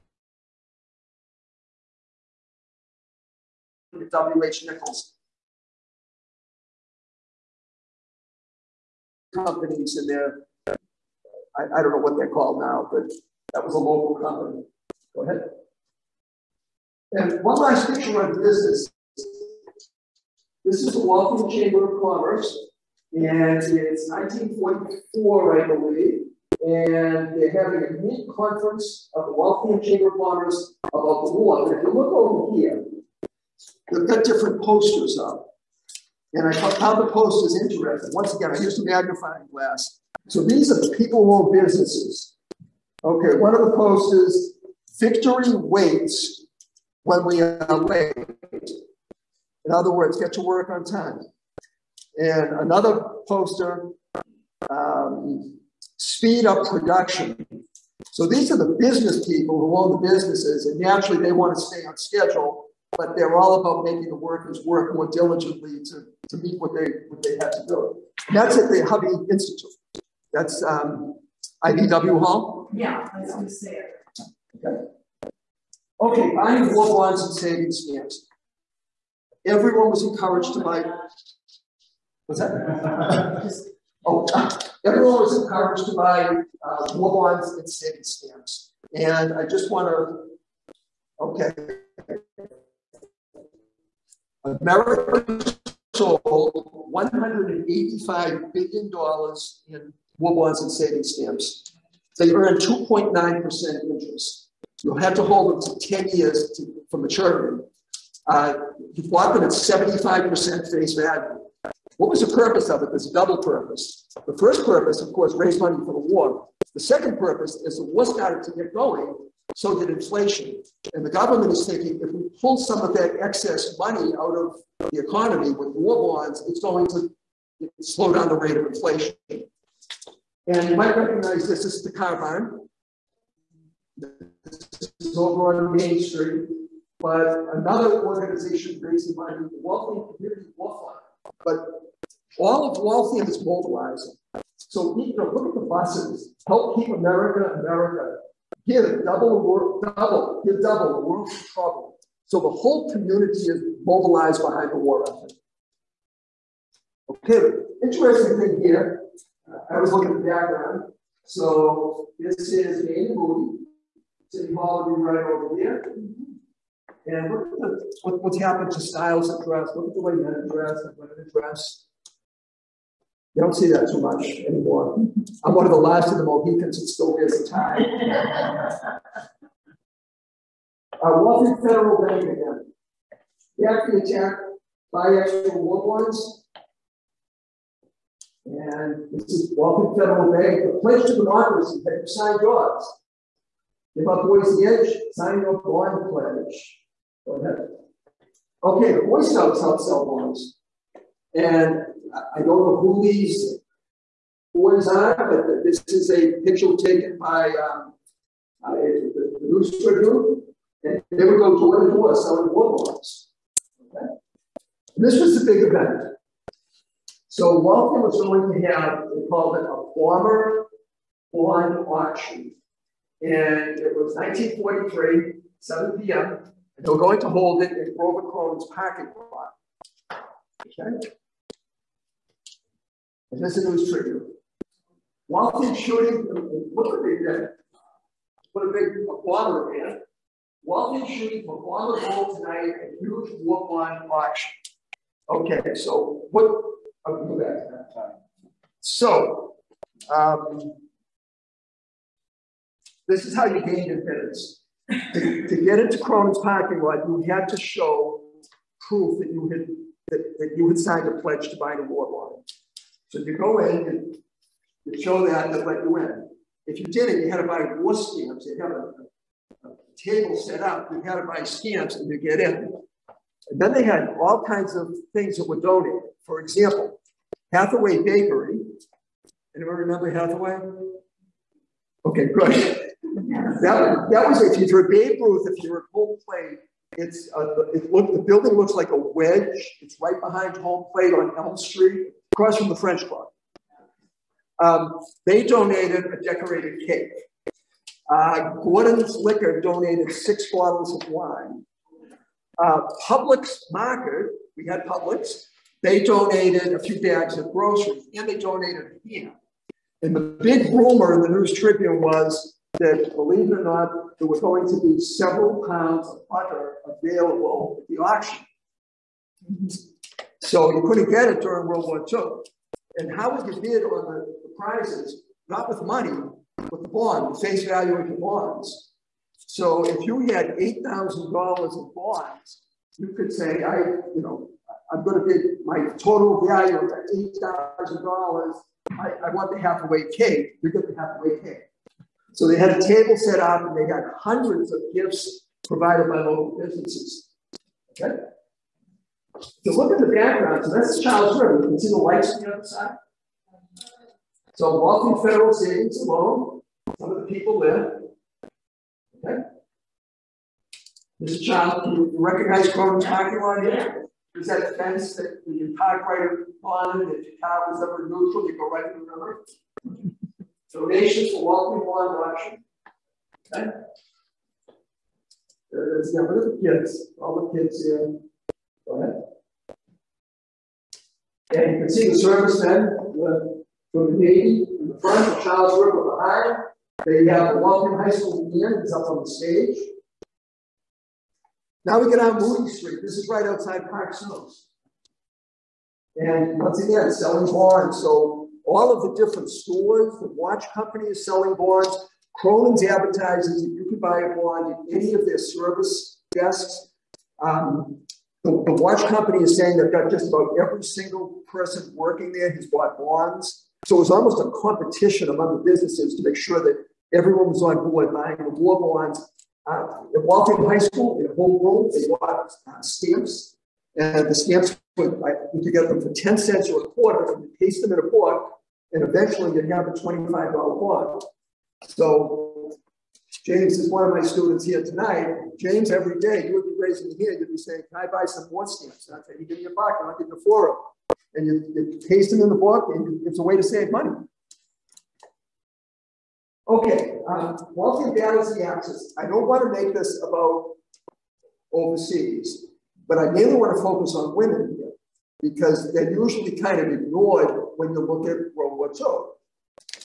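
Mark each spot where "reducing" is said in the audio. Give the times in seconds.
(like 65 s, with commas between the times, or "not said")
not said.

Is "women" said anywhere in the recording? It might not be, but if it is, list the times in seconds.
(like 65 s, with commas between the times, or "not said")
170 s, 454 s.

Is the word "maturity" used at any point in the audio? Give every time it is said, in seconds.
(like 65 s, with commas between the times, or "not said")
106 s.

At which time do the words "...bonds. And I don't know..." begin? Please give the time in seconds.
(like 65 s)
200 s.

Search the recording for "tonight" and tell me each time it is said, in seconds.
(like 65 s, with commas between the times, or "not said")
242 s, 434 s.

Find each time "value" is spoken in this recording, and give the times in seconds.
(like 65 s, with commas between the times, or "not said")
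110 s, 327 s, 336 s.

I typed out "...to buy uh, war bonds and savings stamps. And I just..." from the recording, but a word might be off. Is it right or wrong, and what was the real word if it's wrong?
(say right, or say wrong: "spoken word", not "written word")
right.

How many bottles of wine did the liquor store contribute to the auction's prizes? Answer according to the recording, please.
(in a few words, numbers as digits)
6.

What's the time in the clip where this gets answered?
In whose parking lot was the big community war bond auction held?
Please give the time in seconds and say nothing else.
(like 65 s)
227 s.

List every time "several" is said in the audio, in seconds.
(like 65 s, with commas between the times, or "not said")
314 s.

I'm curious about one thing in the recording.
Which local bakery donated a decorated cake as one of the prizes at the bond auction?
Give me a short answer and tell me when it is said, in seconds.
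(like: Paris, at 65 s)
Hathaway Bakery, at 277 s.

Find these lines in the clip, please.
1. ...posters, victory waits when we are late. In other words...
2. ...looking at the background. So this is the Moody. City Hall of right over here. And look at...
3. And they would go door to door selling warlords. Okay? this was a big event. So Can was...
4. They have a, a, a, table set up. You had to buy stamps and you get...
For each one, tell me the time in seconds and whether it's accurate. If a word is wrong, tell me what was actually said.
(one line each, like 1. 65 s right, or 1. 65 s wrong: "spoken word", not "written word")
1. 43 s right
2. 159 s right
3. 210 s wrong: "Walter", not "Can"
4. 268 s right.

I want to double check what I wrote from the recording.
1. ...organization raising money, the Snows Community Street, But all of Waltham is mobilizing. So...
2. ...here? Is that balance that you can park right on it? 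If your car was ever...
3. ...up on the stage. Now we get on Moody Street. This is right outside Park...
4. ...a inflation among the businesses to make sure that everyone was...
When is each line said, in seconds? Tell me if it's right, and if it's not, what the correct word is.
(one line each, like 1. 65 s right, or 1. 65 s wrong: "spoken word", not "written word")
1. 138 s wrong: "Waltham", not "Snows"
2. 363 s wrong: "fence", not "balance"
3. 388 s right
4. 414 s wrong: "competition", not "inflation".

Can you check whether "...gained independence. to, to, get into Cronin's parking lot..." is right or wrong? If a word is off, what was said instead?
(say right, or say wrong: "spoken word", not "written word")
right.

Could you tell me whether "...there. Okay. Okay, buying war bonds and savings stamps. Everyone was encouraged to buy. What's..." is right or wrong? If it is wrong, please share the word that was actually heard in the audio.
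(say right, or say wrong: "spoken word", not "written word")
right.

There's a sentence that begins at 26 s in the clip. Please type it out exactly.
And they're having a mid conference of the Waltham Chamber of Commerce about the war.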